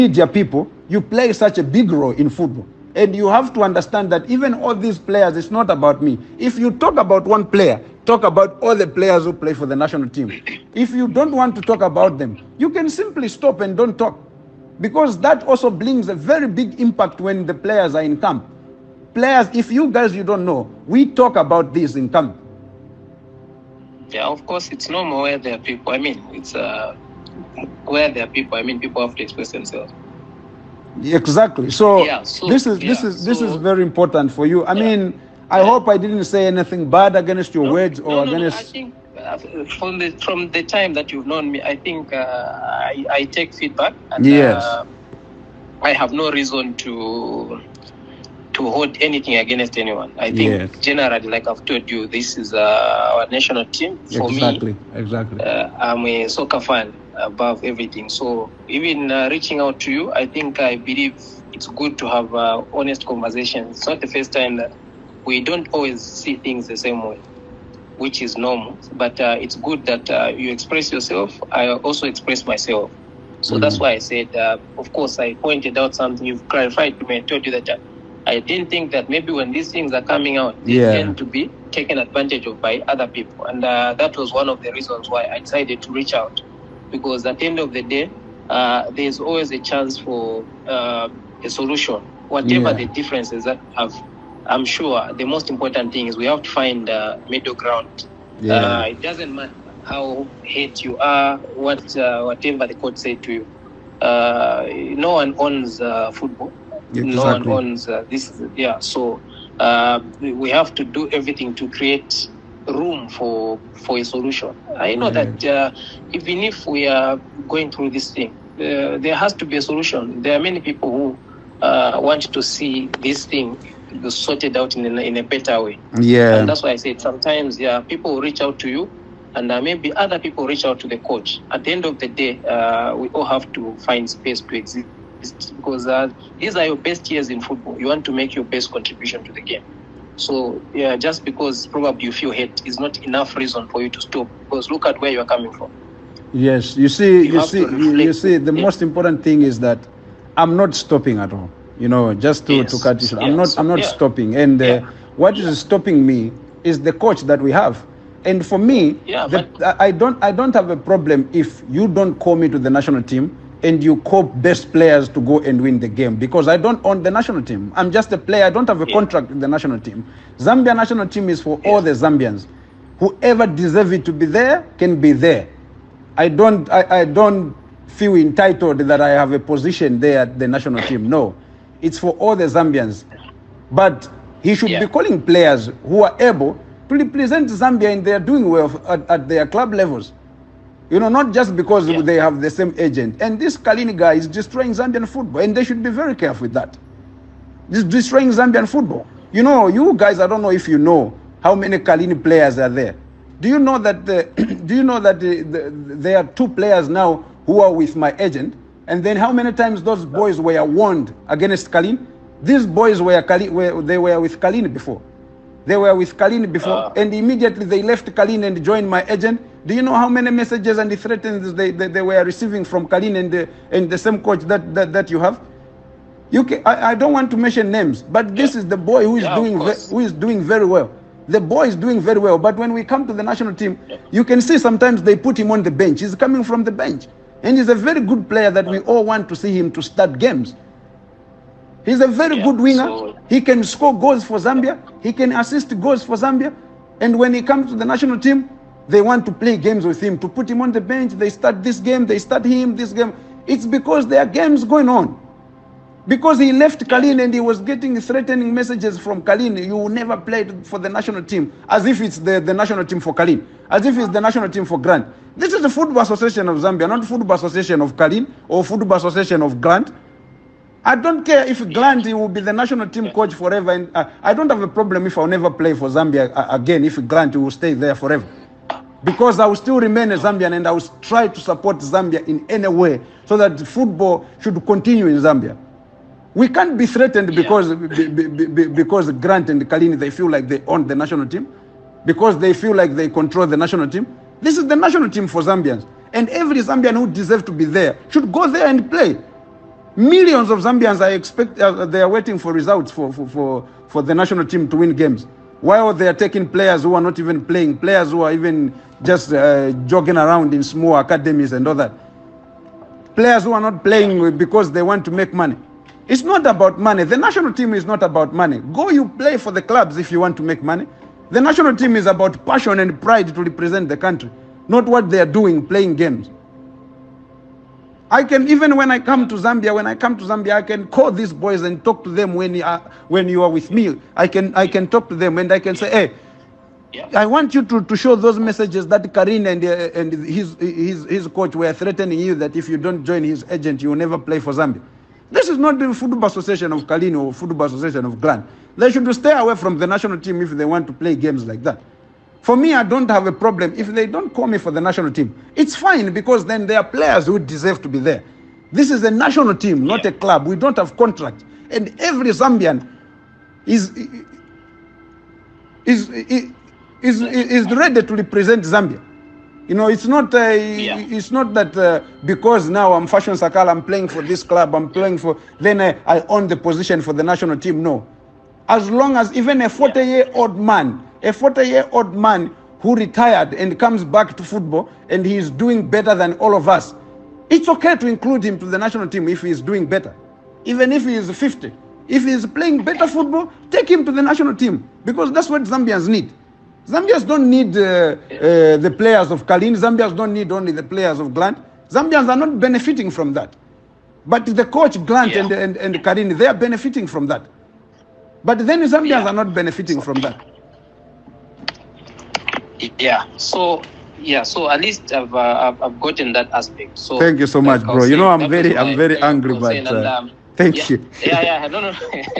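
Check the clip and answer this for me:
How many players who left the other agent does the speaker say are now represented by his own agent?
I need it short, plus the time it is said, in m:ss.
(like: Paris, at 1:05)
2, at 3:26.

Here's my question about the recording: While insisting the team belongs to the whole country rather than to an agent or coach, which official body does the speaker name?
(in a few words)
Football Association of Zambia.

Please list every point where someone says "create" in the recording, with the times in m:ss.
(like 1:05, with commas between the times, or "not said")
1:51.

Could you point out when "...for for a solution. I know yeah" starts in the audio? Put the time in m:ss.
1:53.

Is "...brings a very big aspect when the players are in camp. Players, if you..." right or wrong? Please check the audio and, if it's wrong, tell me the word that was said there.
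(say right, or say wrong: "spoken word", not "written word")
wrong: "impact", not "aspect".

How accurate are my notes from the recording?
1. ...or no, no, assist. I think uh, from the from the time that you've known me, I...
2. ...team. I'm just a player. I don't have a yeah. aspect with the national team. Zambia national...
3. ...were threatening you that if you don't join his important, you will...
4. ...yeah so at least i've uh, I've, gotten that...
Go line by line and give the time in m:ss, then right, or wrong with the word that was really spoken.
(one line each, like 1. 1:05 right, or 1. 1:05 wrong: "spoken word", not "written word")
1. 0:37 wrong: "against", not "assist"
2. 2:47 wrong: "contract", not "aspect"
3. 5:41 wrong: "agent", not "important"
4. 6:54 right.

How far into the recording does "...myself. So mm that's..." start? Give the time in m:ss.
1:12.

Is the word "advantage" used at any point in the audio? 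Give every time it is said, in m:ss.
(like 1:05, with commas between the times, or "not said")
1:21.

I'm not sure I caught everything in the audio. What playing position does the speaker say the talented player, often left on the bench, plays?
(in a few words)
Winger.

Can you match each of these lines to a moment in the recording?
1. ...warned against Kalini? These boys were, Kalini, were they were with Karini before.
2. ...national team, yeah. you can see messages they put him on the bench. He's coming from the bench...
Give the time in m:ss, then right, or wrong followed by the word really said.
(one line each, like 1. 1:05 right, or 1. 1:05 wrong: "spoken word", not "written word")
1. 3:30 wrong: "Kalini", not "Karini"
2. 3:53 wrong: "sometimes", not "messages".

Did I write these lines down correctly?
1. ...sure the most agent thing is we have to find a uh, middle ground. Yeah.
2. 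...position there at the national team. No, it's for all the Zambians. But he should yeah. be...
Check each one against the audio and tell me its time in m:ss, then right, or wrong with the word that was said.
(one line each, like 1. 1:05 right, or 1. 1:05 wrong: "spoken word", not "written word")
1. 1:34 wrong: "important", not "agent"
2. 2:59 right.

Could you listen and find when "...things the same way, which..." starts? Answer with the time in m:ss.
1:06.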